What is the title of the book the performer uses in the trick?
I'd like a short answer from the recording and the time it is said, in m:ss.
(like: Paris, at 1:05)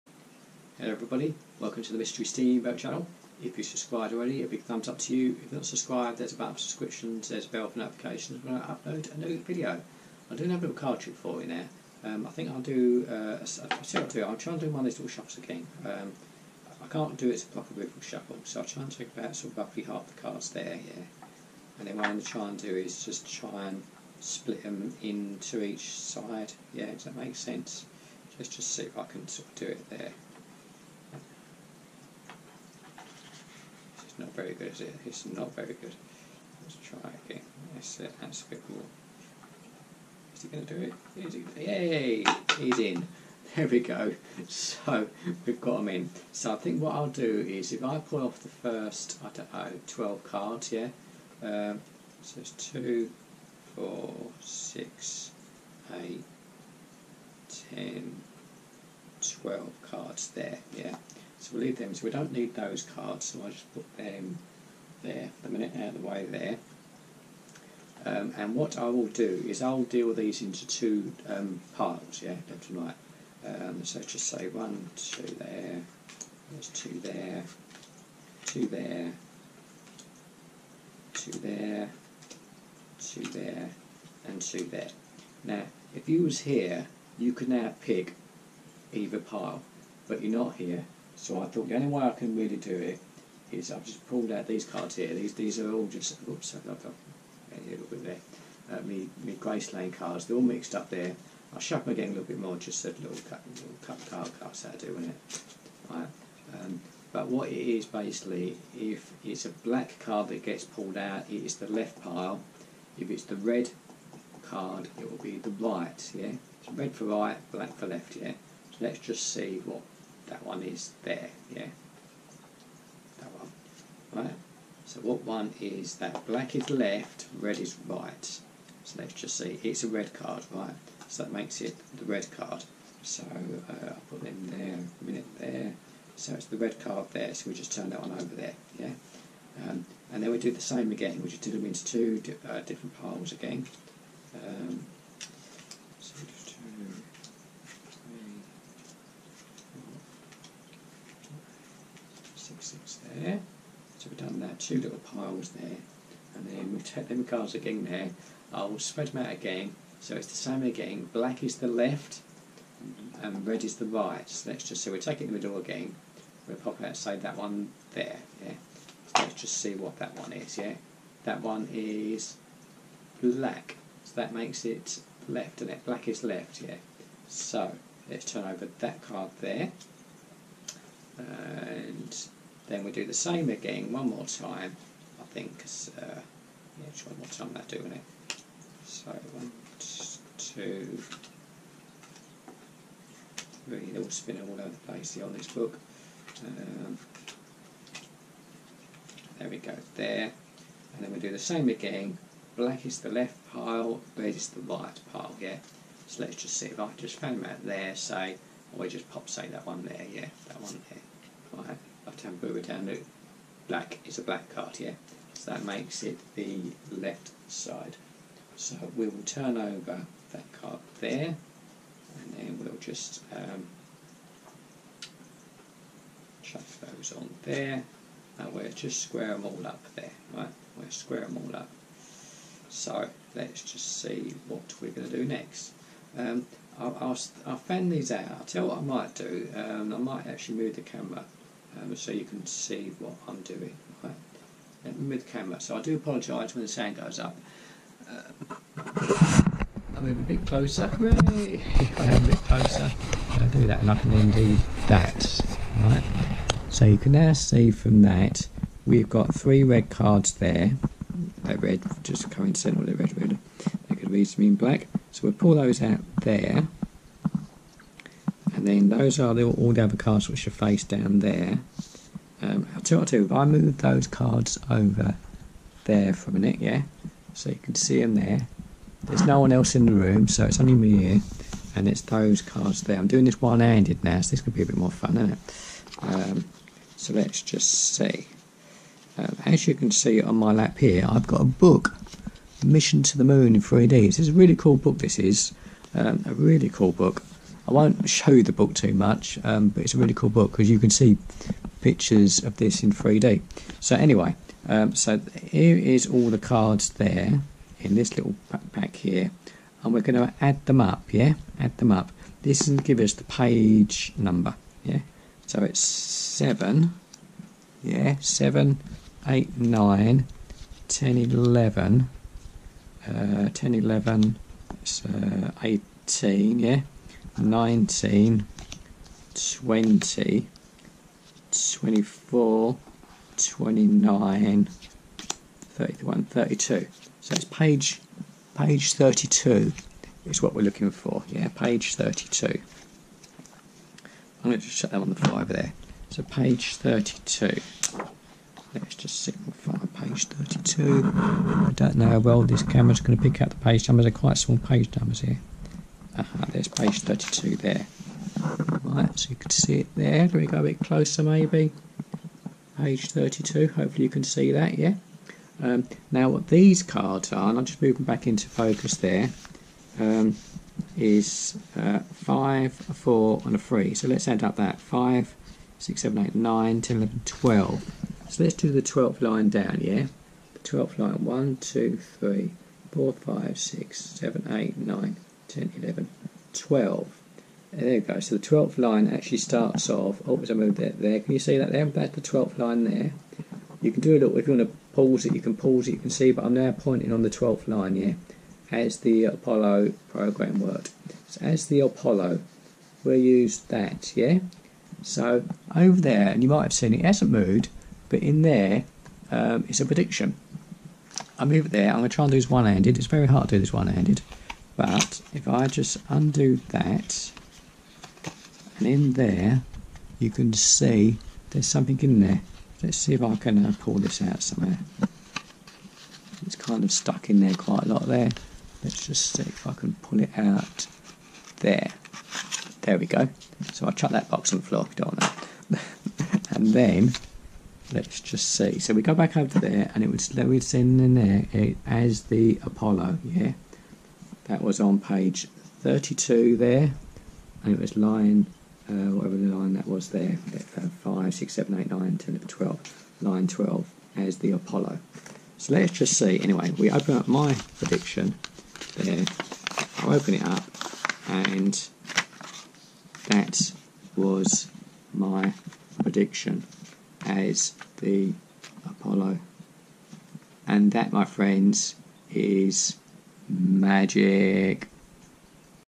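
Mission to the Moon in 3D, at 4:52.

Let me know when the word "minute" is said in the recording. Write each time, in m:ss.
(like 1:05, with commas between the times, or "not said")
1:05, 2:15, 4:36.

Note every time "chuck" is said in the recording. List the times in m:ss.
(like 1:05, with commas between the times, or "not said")
3:46, 7:13.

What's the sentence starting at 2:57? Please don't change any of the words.
So let's turn over that card there.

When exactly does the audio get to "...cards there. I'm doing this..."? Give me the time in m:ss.
4:42.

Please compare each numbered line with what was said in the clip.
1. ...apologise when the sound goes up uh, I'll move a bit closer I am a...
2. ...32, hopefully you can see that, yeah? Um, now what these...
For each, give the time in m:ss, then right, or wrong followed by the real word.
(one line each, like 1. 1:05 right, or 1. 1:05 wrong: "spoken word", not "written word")
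1. 4:05 right
2. 6:03 right.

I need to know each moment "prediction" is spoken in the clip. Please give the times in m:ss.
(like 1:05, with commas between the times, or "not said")
6:49, 7:37, 7:46.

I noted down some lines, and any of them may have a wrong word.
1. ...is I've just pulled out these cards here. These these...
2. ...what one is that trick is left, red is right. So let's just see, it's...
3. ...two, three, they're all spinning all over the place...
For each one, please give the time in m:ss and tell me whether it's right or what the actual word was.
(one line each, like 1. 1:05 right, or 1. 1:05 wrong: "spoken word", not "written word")
1. 1:33 right
2. 2:05 wrong: "black", not "trick"
3. 3:10 right.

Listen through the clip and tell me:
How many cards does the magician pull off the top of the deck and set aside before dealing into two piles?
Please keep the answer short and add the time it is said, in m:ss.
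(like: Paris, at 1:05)
12, at 0:59.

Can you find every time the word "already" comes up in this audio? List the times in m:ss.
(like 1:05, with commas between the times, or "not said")
0:04.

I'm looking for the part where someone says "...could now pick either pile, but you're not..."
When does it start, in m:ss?
1:27.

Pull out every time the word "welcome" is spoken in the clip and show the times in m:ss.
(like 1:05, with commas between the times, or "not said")
0:01.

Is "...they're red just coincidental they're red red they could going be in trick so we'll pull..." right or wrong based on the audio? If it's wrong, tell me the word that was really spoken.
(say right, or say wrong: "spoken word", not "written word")
wrong: "black", not "trick".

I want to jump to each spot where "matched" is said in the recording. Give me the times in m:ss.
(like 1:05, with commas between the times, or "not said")
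not said.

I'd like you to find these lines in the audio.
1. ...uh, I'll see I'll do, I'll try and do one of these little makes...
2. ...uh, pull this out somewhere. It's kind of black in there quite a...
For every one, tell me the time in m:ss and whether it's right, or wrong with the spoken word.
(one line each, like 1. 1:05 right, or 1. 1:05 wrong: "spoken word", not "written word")
1. 0:13 wrong: "shuffles", not "makes"
2. 7:03 wrong: "stuck", not "black".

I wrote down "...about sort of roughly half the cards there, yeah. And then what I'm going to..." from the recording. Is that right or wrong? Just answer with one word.
right.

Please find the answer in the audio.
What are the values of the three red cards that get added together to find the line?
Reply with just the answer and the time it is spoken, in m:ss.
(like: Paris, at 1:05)
5, 4 and 3, at 6:11.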